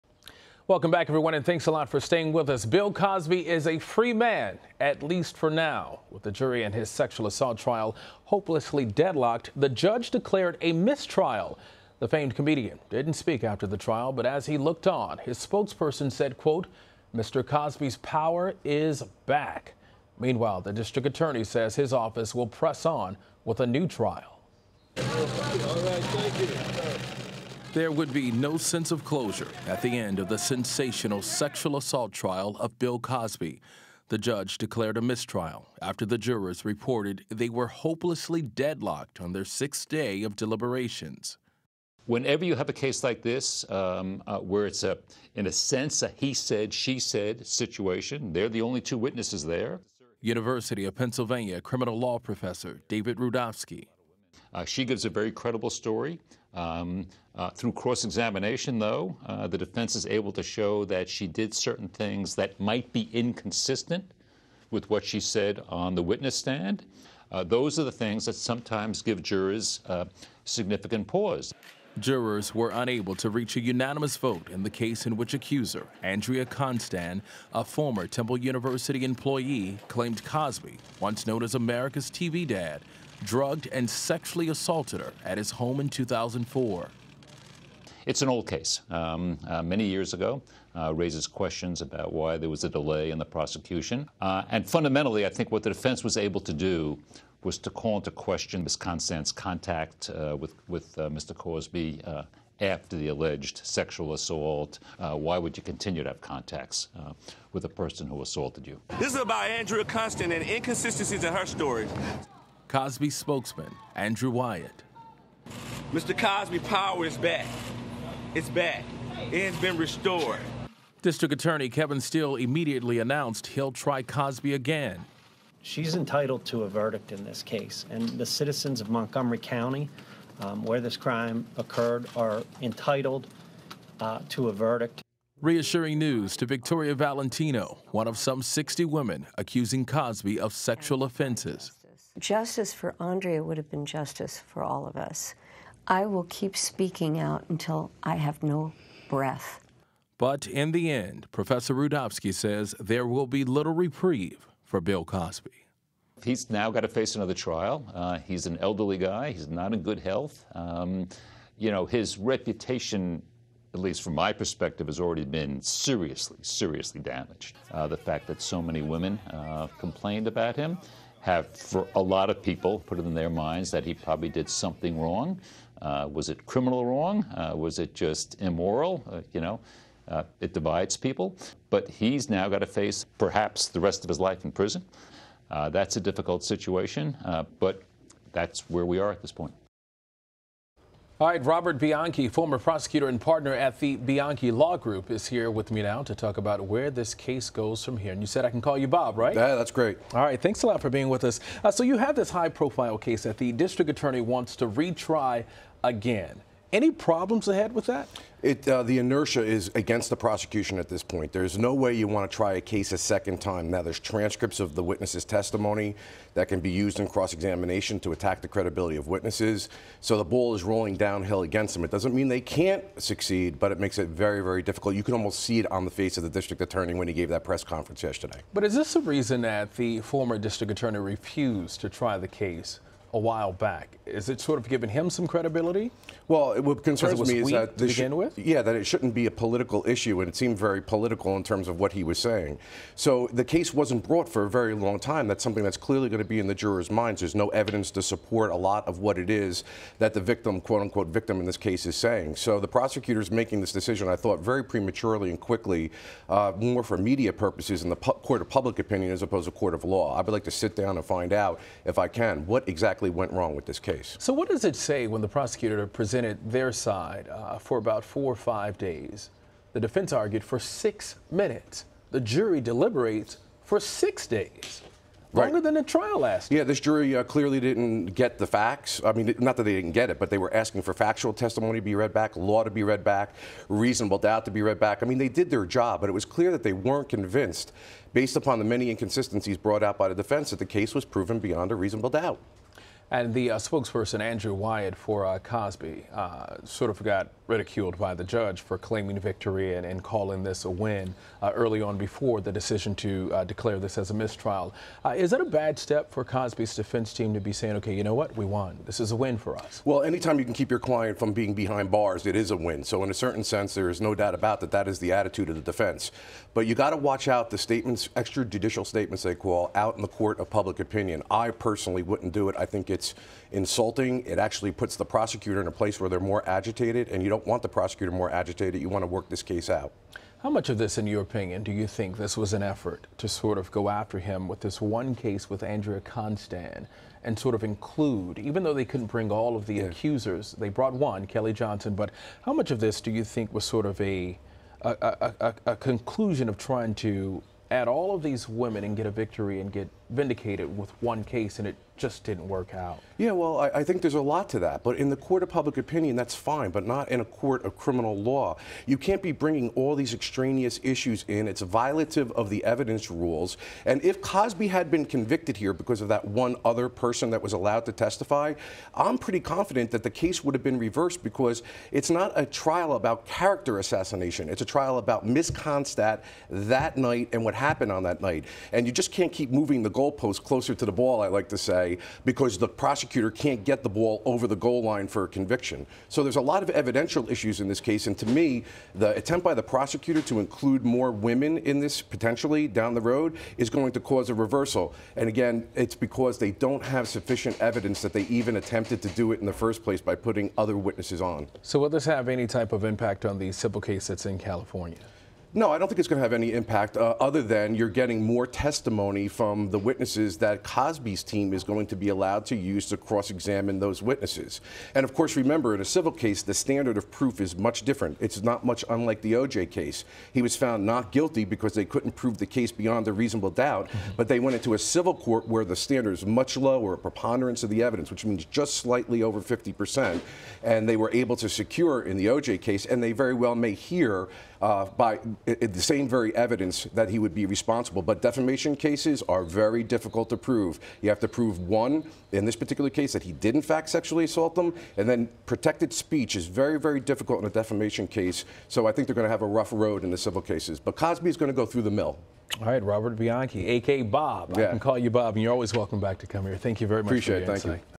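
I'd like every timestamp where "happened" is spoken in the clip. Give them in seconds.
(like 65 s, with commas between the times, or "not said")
377 s.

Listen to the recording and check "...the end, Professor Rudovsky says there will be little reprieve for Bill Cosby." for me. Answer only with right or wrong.
right.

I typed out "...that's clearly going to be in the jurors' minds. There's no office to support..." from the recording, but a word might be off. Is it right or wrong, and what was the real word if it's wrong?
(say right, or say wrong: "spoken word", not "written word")
wrong: "evidence", not "office".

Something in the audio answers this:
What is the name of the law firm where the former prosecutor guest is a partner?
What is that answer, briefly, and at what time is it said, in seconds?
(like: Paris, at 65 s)
Bianchi Law Group, at 193 s.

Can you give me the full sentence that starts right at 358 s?
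You can't be bringing all these extraneous issues in.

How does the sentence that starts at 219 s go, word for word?
So the ball is rolling downhill against them.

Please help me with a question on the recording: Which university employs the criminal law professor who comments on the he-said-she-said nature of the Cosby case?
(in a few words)
University of Pennsylvania.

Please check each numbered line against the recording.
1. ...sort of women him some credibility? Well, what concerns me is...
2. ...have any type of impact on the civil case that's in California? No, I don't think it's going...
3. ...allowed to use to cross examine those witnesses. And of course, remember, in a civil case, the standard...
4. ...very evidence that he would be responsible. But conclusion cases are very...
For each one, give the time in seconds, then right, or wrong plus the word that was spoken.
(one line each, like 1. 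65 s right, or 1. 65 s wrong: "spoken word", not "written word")
1. 234 s wrong: "given", not "women"
2. 402 s right
3. 412 s right
4. 436 s wrong: "defamation", not "conclusion".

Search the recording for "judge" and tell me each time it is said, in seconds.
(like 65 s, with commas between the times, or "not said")
9 s, 34 s, 298 s.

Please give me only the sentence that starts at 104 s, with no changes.
Uh, why would you continue to have contacts uh, with a person who assaulted you?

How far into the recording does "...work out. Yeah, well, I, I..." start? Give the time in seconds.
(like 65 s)
352 s.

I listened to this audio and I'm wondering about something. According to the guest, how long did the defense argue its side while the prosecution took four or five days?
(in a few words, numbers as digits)
6 minutes.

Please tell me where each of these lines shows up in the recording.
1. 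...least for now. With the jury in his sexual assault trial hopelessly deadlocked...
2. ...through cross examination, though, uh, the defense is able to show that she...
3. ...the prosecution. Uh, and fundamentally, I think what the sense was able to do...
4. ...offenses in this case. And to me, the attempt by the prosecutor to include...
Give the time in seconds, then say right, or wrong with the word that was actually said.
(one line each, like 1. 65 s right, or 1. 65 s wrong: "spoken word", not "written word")
1. 5 s right
2. 57 s right
3. 93 s wrong: "defense", not "sense"
4. 387 s wrong: "issues", not "offenses".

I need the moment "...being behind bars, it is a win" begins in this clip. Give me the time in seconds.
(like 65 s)
311 s.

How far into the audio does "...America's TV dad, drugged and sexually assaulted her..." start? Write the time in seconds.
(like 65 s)
81 s.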